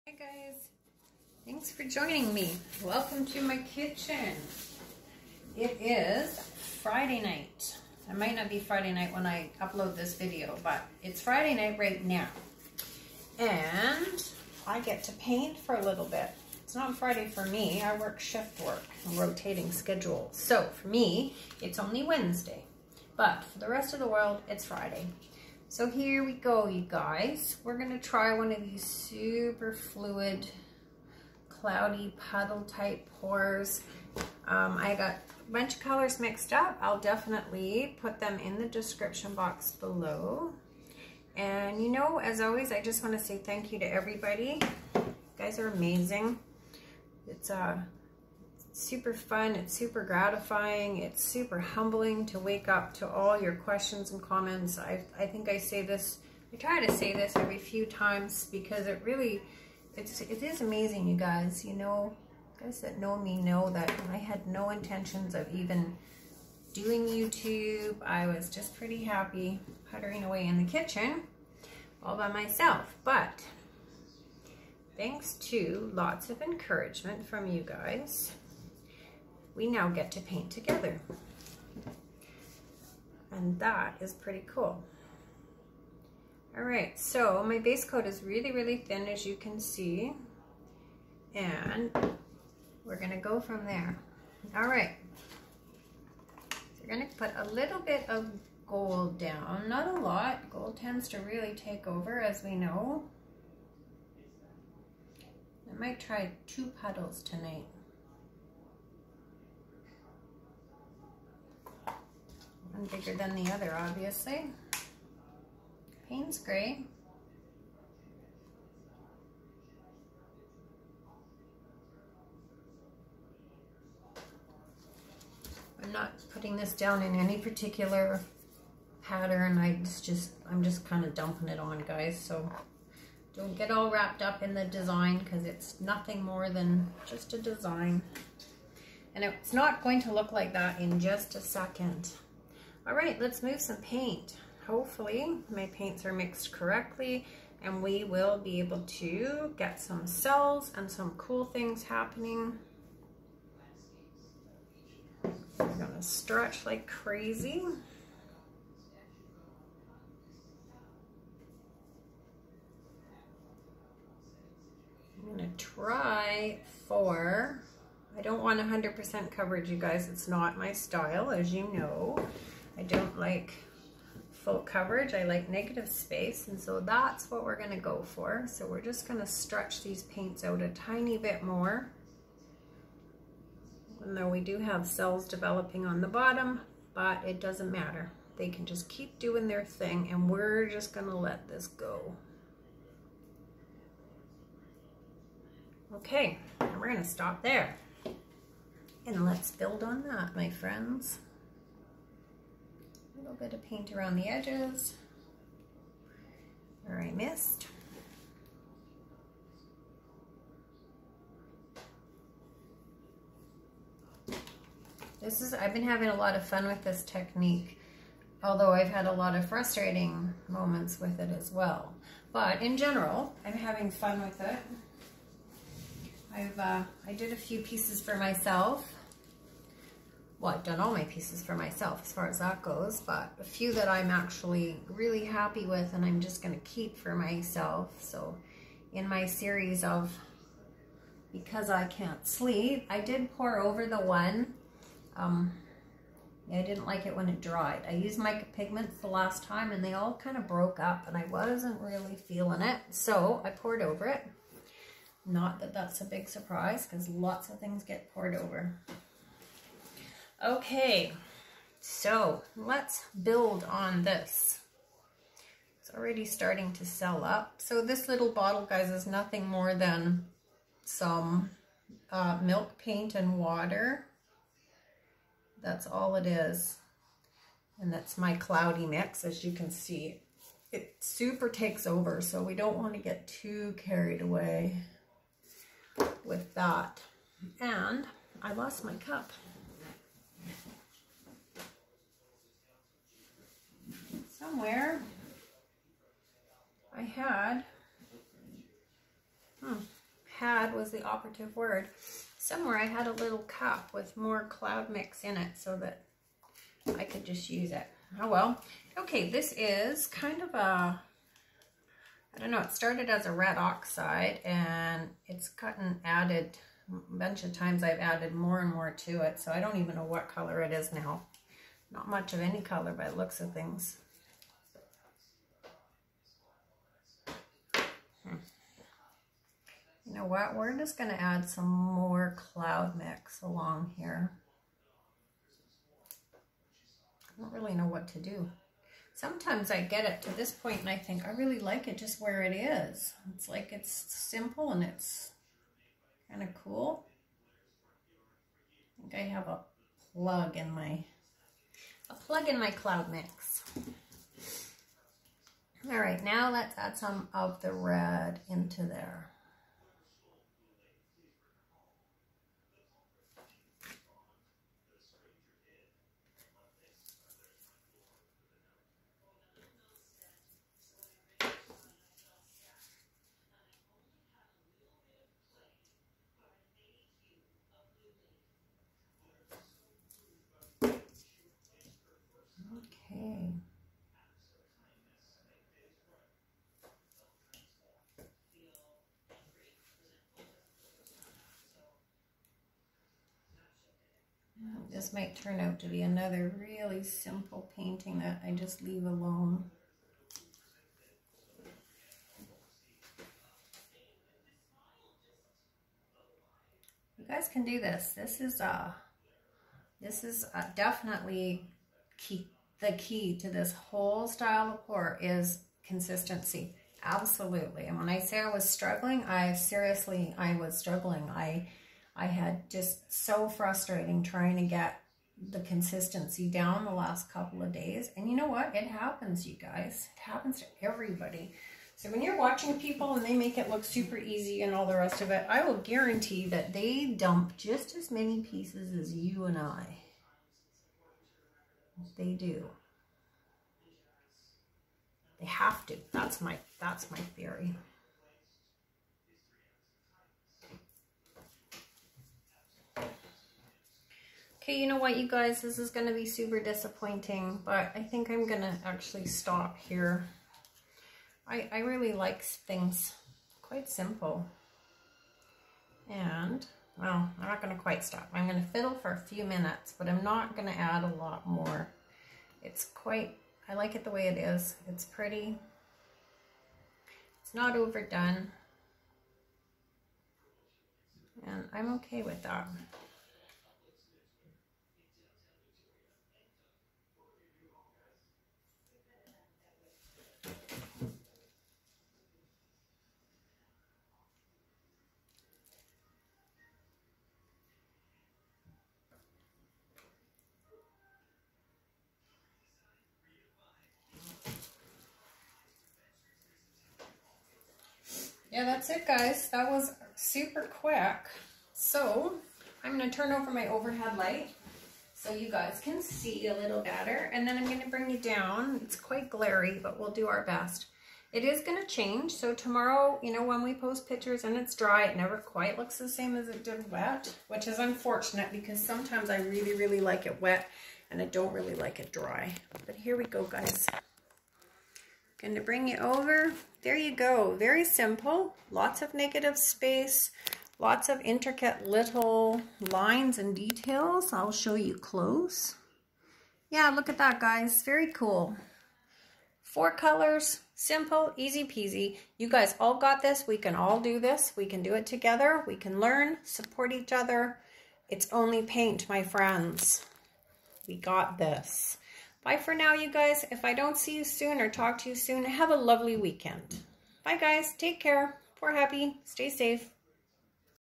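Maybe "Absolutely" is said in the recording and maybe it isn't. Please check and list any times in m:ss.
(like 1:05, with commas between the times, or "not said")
6:57.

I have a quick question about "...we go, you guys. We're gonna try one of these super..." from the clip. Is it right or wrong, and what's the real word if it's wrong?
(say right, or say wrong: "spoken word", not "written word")
right.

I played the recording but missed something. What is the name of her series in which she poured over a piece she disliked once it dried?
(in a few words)
Because I Can't Sleep.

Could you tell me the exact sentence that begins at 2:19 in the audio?
And it's not going to look like that in just a second.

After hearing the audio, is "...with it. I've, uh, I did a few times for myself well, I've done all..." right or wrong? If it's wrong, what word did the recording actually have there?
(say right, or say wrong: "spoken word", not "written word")
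wrong: "pieces", not "times".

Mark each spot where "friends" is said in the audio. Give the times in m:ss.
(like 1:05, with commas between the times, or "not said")
3:20, 9:19.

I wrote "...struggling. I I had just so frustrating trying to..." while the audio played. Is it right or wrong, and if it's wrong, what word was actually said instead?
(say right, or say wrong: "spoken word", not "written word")
right.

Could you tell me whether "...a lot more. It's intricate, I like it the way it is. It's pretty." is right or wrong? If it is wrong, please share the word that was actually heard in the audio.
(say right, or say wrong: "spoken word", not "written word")
wrong: "quite", not "intricate".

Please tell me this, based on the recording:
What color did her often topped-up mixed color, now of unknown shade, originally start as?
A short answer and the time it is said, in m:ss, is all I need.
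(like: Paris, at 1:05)
Red oxide, at 5:13.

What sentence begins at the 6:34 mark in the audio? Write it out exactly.
This might turn out to be another really simple painting that I just leave alone.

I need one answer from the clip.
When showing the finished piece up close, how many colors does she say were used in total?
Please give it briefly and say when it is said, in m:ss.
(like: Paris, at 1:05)
4, at 9:09.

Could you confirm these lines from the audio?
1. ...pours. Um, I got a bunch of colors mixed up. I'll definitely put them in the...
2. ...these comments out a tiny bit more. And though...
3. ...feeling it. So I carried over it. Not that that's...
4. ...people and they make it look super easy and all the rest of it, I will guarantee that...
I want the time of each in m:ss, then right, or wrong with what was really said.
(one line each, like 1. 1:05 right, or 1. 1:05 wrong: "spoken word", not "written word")
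1. 0:33 right
2. 2:59 wrong: "paints", not "comments"
3. 4:12 wrong: "poured", not "carried"
4. 7:12 right.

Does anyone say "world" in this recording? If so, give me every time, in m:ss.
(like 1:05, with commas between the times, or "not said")
0:24.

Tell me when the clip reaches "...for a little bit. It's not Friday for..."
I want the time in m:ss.
0:15.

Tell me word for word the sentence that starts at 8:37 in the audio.
And then I'm going to bring you down.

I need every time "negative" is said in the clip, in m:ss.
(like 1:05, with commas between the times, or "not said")
2:55, 8:59.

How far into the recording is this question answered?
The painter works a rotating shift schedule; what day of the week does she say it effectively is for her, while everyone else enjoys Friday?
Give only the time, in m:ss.
0:22.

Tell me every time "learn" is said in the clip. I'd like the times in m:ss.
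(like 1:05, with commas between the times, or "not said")
9:15.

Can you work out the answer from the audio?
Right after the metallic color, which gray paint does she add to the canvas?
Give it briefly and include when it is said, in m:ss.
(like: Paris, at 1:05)
Payne's gray, at 1:56.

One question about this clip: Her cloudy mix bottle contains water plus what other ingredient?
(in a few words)
Milk paint.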